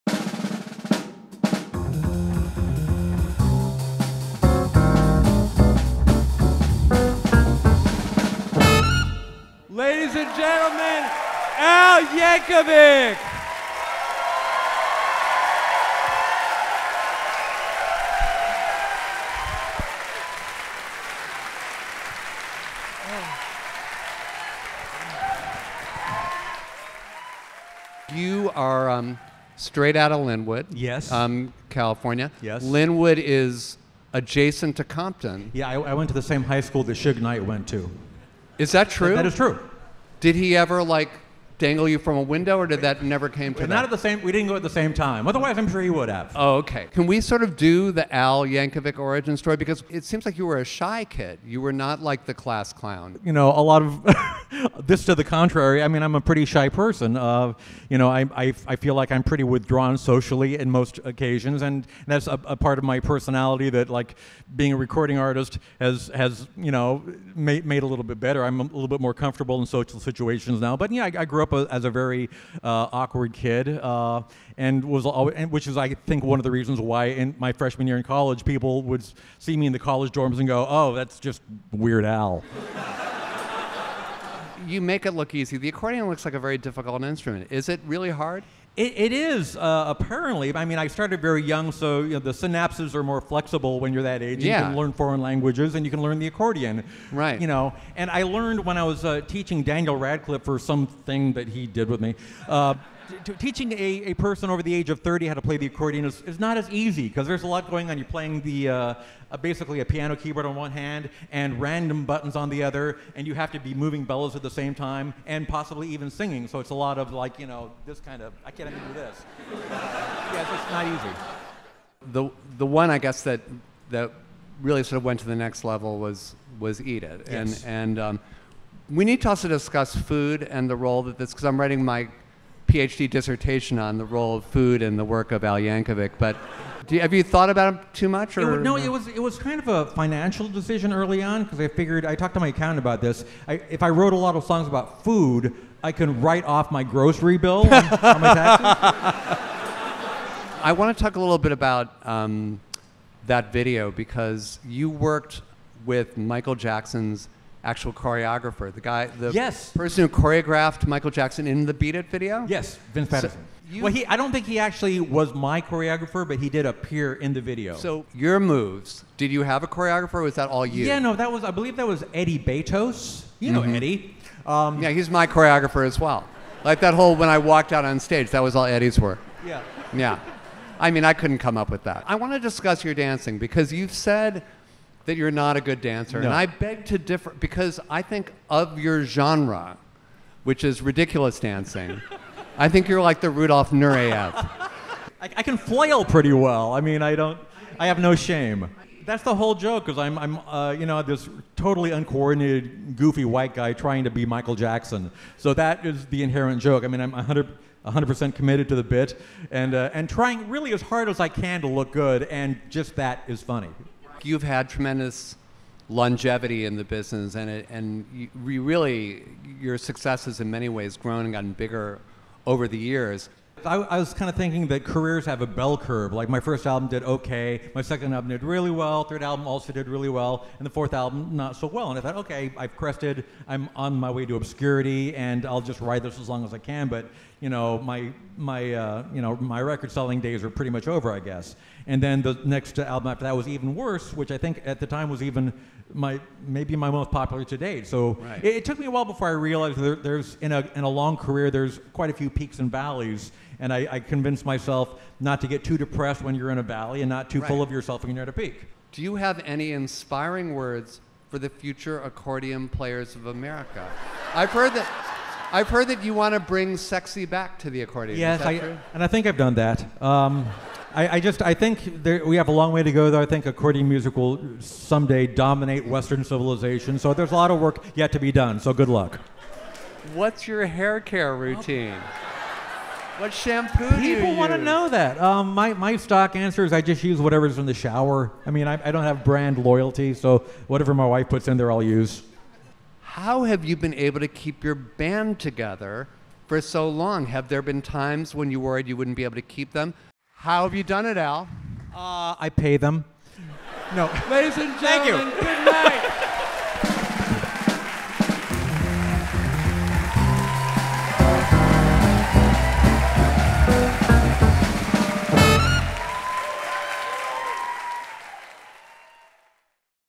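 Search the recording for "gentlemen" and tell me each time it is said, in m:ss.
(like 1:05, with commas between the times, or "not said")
0:10, 5:04.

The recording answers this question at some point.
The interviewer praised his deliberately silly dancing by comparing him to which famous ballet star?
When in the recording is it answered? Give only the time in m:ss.
3:13.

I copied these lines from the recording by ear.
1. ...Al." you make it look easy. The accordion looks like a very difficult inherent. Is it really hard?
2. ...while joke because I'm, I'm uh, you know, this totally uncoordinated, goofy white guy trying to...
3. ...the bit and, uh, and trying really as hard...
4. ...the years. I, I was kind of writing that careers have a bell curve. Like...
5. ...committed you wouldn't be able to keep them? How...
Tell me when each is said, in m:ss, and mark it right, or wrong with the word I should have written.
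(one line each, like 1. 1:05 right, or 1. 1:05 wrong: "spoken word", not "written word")
1. 1:22 wrong: "instrument", not "inherent"
2. 3:19 wrong: "whole", not "while"
3. 3:28 right
4. 3:42 wrong: "thinking", not "writing"
5. 4:58 wrong: "worried", not "committed".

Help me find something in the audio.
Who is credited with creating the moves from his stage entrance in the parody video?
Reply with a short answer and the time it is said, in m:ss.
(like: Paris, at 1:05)
Eddie Betos, at 2:52.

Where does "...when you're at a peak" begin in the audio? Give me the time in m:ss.
4:18.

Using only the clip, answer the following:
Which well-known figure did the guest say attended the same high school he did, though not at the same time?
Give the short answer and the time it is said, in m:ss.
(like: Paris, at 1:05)
Suge Knight, at 0:36.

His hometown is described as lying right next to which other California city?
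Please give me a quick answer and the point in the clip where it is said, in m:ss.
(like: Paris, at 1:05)
Compton, at 0:34.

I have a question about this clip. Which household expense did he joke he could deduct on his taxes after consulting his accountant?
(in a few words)
grocery bill.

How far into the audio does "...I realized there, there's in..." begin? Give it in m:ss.
4:09.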